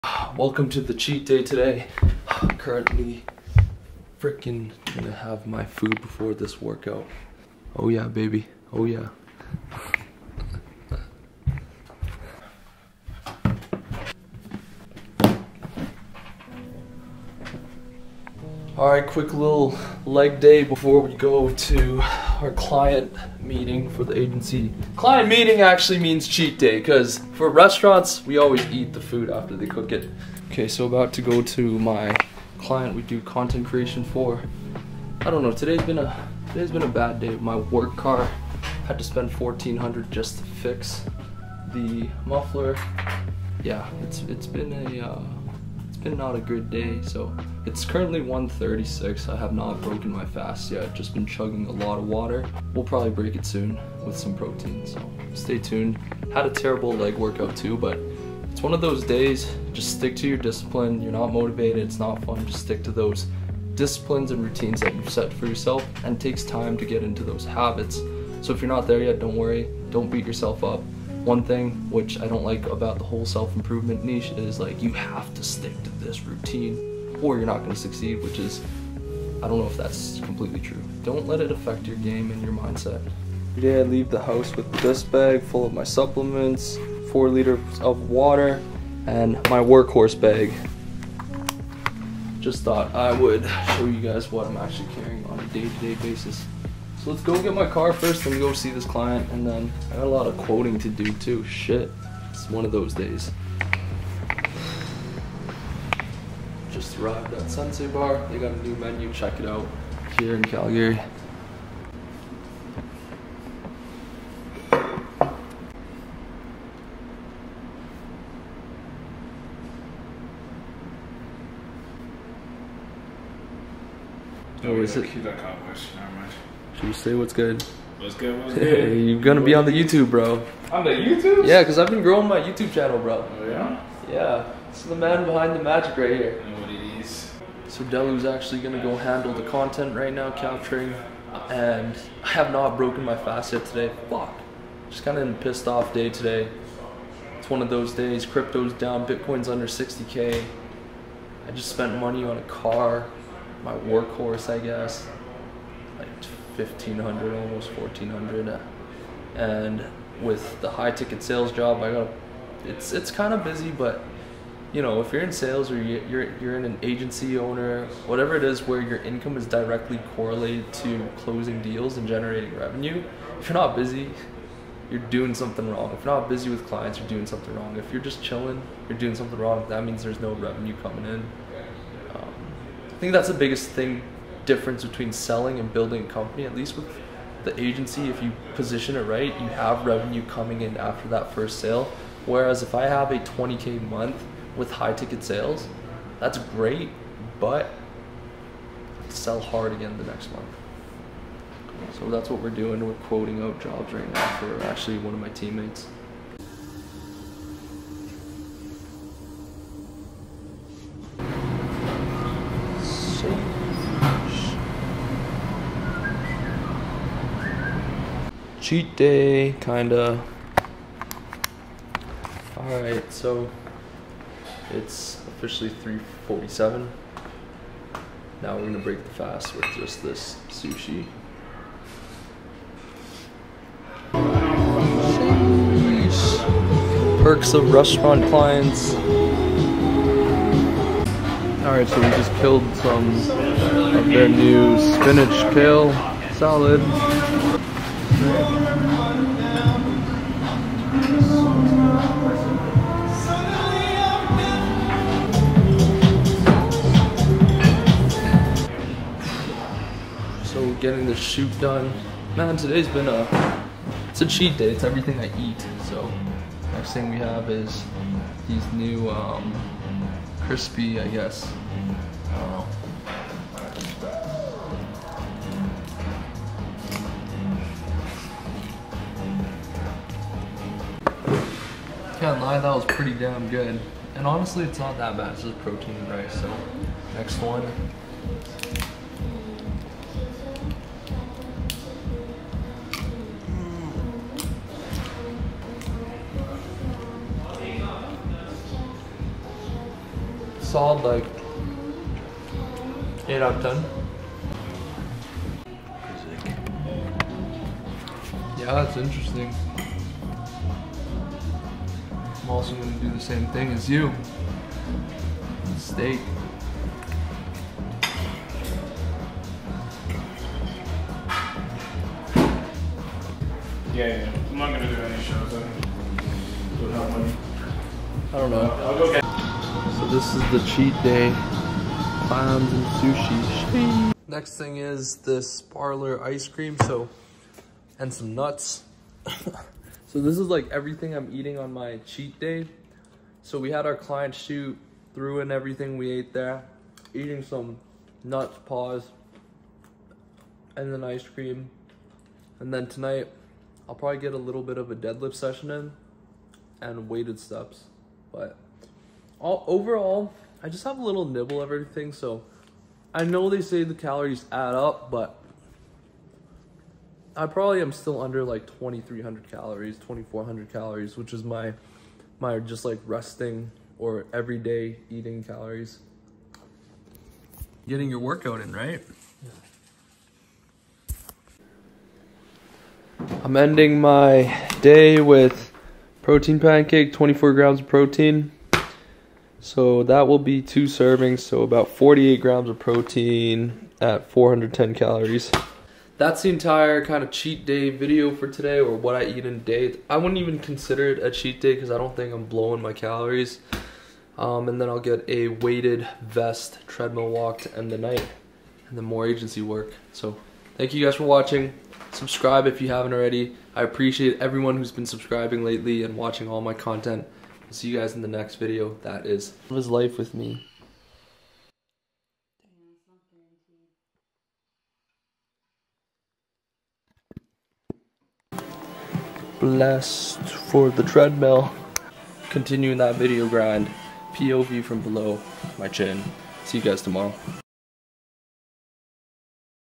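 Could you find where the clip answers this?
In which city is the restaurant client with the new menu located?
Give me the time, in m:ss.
1:50.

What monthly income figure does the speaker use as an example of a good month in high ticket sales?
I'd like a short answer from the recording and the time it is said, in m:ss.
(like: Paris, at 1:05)
20K, at 3:13.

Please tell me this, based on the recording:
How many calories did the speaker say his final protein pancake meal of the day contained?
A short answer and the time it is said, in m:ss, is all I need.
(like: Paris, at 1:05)
410, at 6:34.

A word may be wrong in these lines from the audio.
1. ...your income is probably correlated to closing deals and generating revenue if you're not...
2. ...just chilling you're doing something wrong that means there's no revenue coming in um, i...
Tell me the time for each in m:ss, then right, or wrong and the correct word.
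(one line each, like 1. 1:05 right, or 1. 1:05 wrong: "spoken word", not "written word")
1. 2:48 wrong: "directly", not "probably"
2. 2:58 right.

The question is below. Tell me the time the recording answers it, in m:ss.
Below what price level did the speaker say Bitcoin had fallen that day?
2:29.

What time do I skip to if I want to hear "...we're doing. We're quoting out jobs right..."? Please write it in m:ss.
3:22.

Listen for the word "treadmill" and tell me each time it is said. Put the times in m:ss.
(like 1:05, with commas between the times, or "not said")
6:46, 7:11.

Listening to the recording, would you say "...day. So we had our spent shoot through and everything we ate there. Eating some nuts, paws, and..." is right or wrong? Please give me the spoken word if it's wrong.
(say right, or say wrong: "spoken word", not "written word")
wrong: "client", not "spent".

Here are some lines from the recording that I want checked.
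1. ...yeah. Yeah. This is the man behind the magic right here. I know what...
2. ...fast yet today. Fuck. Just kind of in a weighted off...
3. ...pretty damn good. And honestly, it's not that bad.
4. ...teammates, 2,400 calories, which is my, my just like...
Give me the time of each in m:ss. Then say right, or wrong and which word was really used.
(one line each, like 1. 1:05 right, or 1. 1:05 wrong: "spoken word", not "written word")
1. 2:13 right
2. 2:23 wrong: "pissed", not "weighted"
3. 4:42 right
4. 6:09 wrong: "calories", not "teammates".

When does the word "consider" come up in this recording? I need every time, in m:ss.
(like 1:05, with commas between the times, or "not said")
6:40.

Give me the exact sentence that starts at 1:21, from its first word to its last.
Don't let it affect your game and your mindset.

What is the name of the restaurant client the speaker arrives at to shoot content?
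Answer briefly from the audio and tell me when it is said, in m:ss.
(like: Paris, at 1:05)
Sensei Bar, at 1:47.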